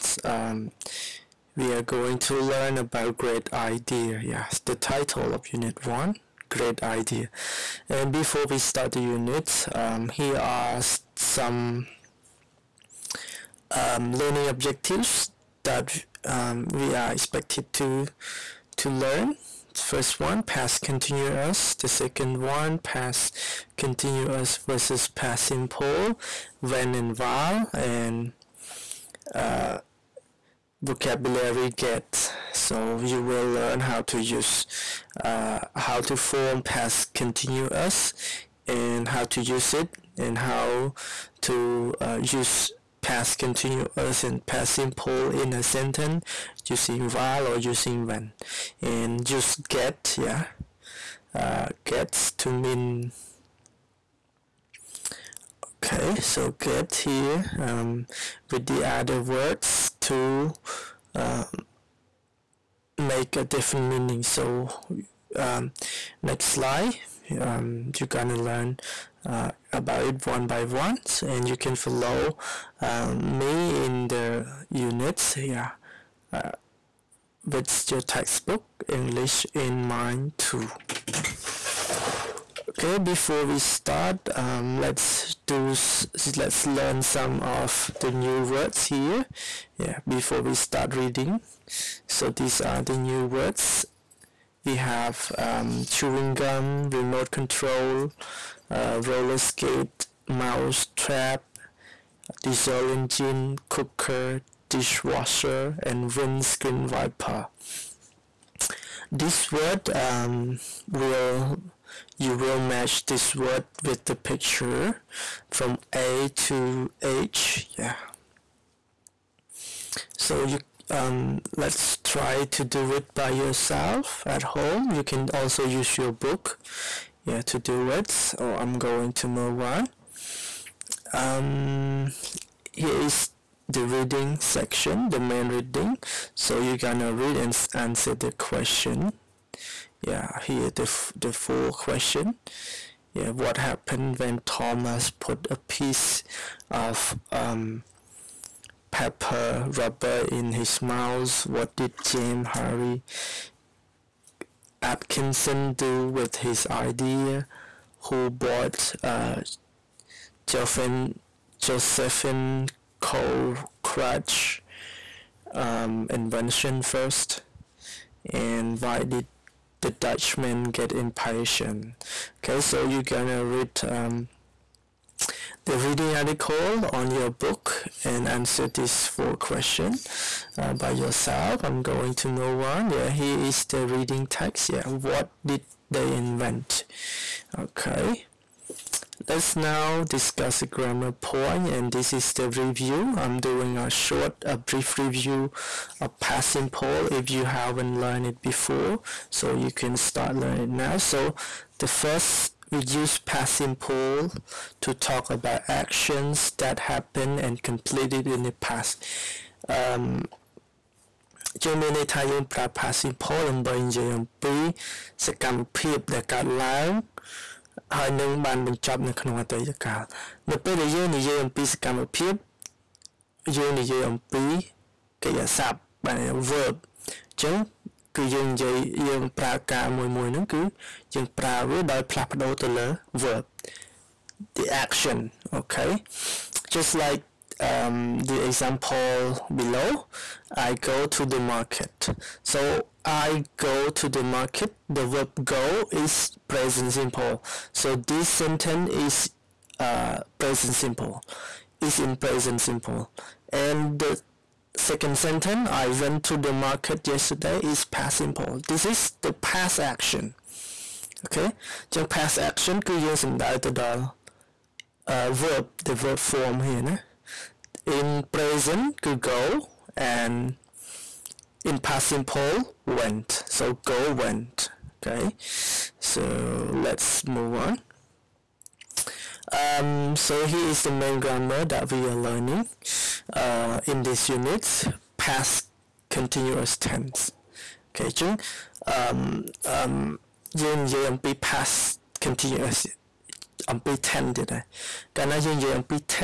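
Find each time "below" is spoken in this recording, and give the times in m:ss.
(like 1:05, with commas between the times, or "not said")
3:59.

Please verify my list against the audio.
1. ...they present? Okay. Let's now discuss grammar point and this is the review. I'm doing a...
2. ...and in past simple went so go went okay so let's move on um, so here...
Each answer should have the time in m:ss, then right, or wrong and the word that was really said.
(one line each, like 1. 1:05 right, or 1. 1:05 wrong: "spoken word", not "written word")
1. 3:05 wrong: "invent", not "present"
2. 4:30 right.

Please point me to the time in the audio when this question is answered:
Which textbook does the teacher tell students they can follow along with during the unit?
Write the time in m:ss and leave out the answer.
1:18.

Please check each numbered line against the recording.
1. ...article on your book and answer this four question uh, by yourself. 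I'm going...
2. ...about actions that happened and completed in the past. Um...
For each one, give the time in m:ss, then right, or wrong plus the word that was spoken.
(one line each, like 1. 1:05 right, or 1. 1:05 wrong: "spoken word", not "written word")
1. 2:56 right
2. 3:25 right.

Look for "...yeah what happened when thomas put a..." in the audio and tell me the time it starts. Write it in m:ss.
2:23.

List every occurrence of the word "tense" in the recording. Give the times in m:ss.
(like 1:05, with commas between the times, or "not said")
4:46, 4:54.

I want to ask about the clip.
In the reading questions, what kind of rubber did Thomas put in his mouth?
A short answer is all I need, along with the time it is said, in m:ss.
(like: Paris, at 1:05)
Pepper rubber, at 2:28.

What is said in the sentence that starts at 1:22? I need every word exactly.
Okay, before we start, um, let's do let's learn some of the new words here.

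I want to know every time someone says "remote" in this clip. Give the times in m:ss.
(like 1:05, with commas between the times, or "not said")
1:36.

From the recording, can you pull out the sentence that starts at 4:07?
So this sentence is uh, present simple, is in present simple.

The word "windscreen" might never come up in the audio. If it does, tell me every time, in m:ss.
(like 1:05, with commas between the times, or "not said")
1:46.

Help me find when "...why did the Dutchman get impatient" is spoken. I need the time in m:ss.
2:48.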